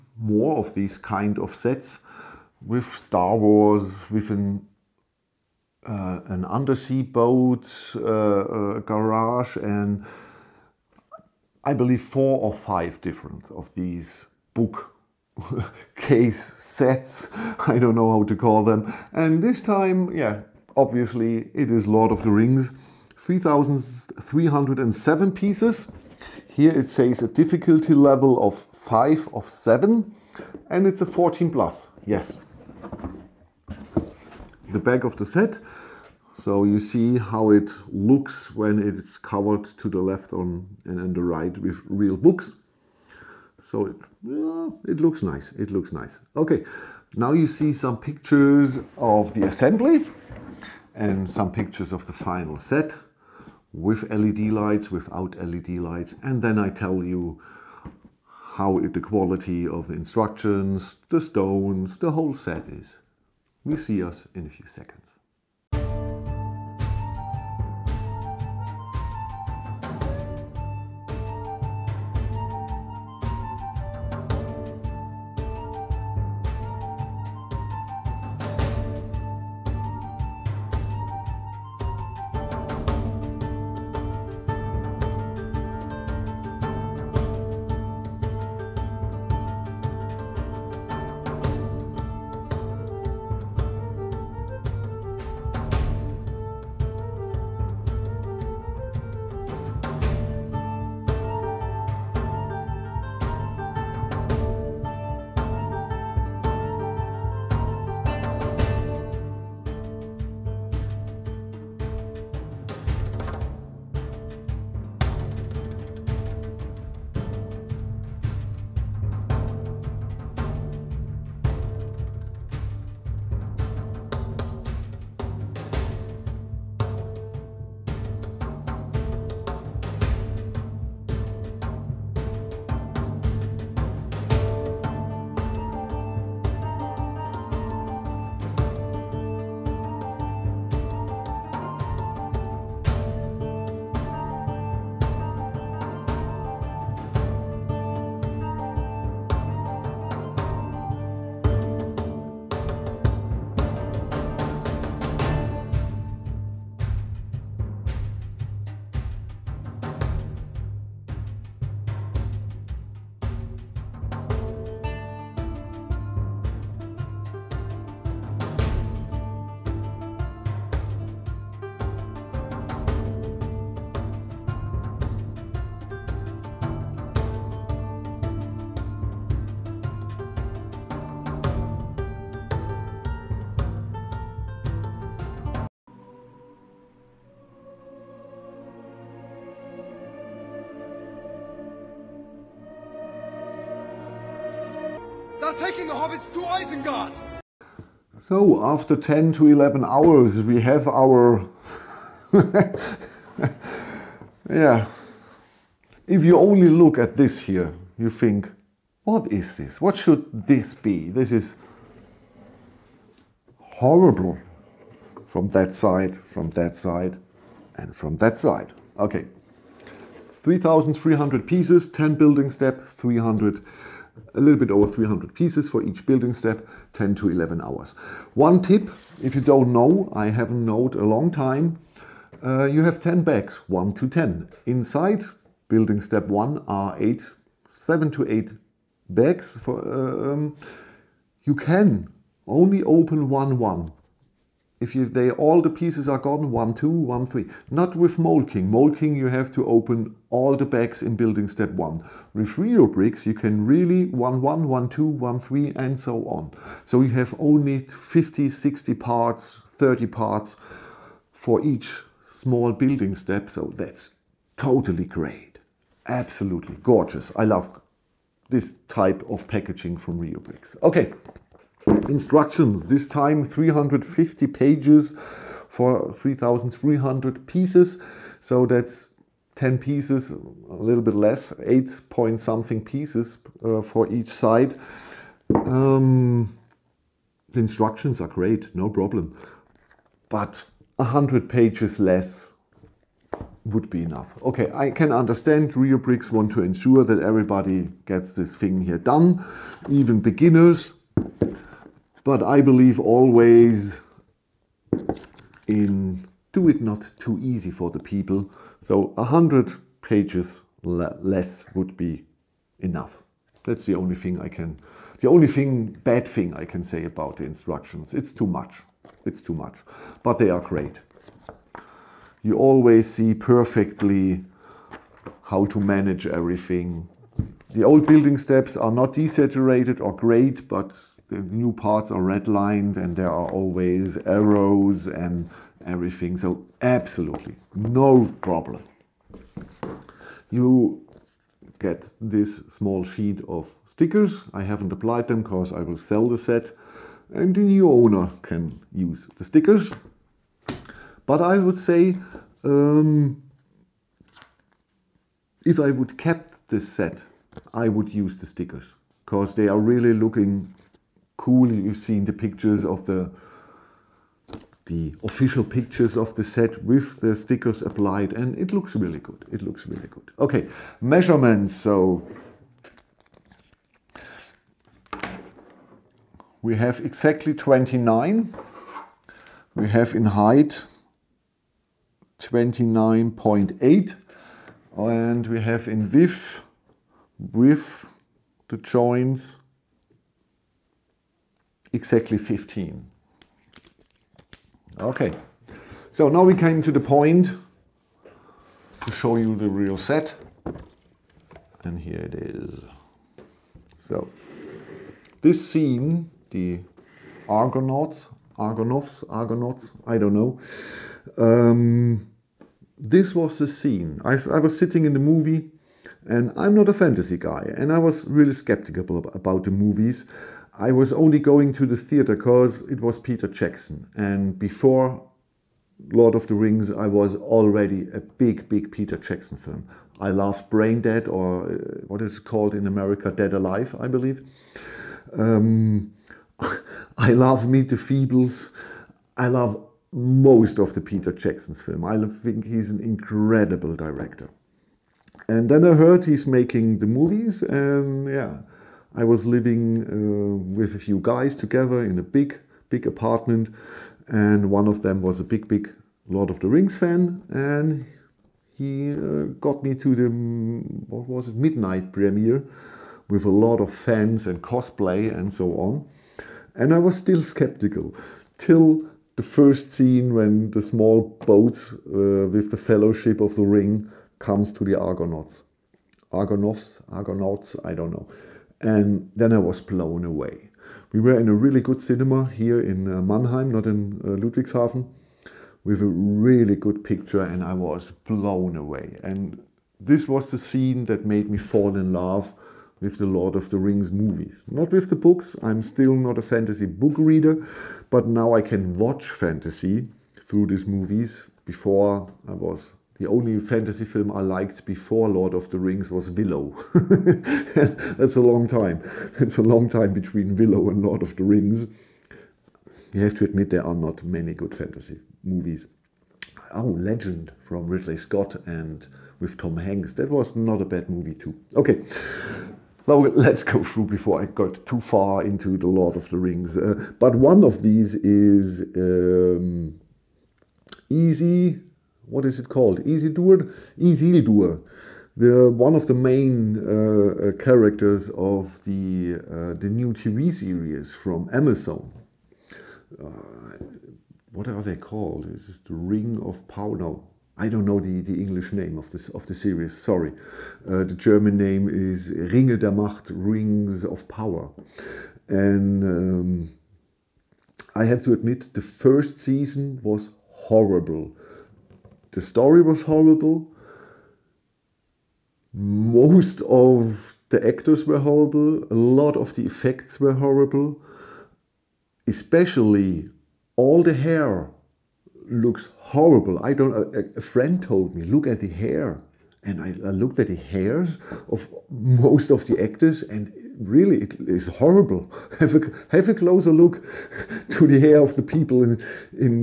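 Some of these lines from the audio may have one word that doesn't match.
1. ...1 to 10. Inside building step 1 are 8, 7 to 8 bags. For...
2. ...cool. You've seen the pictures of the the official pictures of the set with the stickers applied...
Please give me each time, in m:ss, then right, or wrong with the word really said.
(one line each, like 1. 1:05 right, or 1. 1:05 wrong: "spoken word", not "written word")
1. 3:53 right
2. 6:01 right.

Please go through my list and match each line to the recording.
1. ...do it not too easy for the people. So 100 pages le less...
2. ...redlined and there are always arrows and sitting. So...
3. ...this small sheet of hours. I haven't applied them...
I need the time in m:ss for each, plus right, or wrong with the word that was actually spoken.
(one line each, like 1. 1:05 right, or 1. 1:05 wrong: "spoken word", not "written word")
1. 5:06 right
2. 5:32 wrong: "everything", not "sitting"
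3. 5:42 wrong: "stickers", not "hours".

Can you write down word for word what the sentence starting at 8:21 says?
Before I was the only fantasy film I liked before Lord of the Rings was Willow.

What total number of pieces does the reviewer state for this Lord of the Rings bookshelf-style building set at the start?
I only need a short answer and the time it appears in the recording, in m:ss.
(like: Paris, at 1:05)
3,307, at 0:23.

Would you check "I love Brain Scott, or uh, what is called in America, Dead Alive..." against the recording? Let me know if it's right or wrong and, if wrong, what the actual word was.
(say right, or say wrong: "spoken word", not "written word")
wrong: "Dead", not "Scott".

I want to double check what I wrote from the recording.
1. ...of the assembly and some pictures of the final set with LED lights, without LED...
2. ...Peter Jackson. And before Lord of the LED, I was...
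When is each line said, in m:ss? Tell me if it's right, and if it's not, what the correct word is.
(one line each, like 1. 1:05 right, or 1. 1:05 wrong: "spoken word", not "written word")
1. 0:48 right
2. 7:03 wrong: "Rings", not "LED".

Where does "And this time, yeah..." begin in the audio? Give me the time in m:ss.
0:19.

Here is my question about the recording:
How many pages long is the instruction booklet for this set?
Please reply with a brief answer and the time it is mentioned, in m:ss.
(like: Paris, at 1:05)
350, at 4:33.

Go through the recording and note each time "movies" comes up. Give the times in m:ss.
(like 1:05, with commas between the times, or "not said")
6:55, 6:59, 7:27, 8:14, 8:20, 8:35, 8:41.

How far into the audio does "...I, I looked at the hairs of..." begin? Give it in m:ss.
9:39.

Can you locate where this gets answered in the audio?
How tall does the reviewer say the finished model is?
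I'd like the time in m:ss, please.
6:22.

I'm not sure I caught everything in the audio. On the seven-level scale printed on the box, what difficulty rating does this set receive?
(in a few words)
5 of 7.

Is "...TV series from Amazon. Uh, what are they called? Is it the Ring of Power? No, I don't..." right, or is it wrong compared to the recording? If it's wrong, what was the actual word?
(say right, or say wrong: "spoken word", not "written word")
right.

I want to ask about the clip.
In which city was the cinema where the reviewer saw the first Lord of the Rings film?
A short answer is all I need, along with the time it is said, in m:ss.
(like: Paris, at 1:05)
Mannheim, at 8:03.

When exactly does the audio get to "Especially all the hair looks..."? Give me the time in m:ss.
9:32.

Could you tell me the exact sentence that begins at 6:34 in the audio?
Okay, so now we came to the point to show you the real set.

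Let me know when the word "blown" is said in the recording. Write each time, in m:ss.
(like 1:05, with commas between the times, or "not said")
7:59, 8:08.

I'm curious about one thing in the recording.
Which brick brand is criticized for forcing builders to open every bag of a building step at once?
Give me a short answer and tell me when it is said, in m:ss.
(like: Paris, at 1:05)
Mould King, at 4:08.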